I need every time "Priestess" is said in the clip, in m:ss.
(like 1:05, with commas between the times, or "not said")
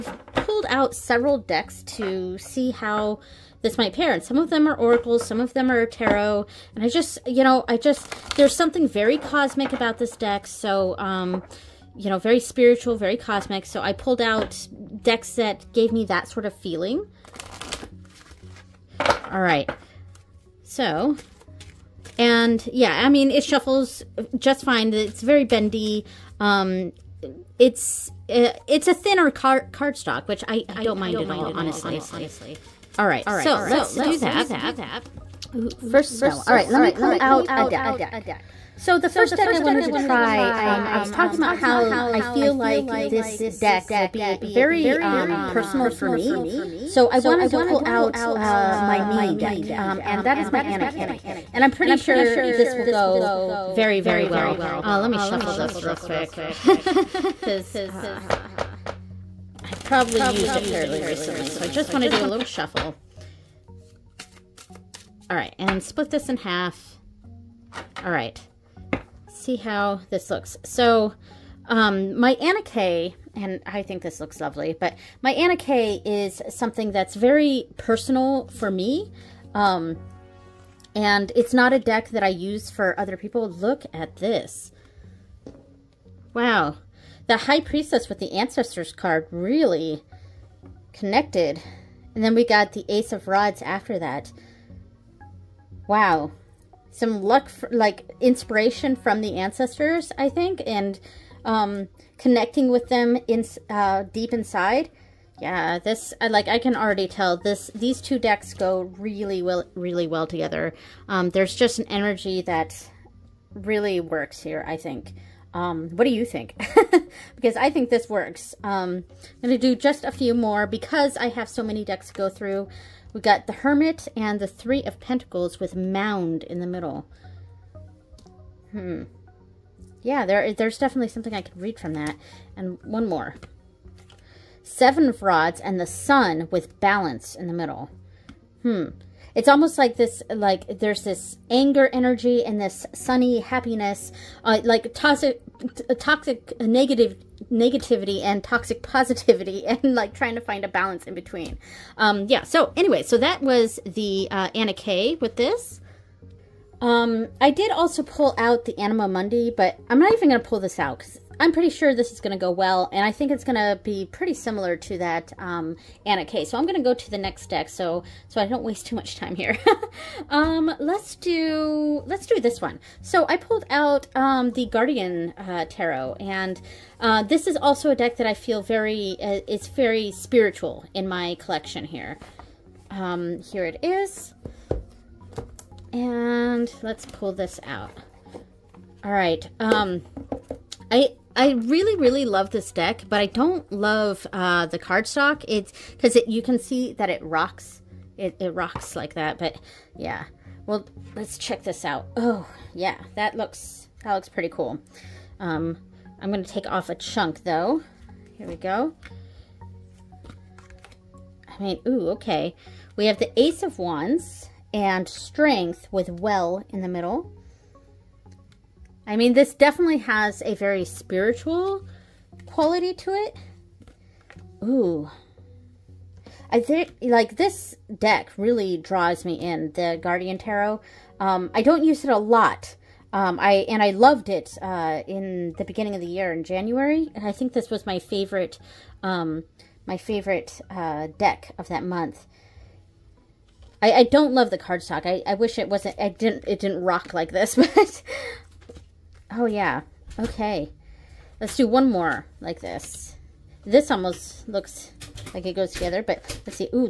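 1:27.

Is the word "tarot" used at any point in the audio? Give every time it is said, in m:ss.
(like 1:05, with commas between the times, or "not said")
0:05, 2:55, 3:50.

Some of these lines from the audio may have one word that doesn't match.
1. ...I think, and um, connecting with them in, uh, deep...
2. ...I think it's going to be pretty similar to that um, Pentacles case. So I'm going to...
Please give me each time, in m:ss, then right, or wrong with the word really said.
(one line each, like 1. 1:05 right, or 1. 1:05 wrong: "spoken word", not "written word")
1. 1:40 right
2. 2:43 wrong: "Anna", not "Pentacles".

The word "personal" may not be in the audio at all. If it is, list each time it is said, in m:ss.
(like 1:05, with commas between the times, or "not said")
0:45, 1:17.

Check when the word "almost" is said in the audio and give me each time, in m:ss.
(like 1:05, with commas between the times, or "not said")
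2:19, 4:13.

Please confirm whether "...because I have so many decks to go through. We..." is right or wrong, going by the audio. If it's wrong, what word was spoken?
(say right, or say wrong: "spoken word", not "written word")
right.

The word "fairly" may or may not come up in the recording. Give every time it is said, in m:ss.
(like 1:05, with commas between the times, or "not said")
1:00.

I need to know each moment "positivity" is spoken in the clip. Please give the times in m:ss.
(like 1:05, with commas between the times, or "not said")
2:28.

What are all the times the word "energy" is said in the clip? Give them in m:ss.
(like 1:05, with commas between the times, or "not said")
1:51, 2:21.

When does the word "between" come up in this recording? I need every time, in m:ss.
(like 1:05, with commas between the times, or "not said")
2:31.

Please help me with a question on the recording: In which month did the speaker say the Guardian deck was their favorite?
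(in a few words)
January.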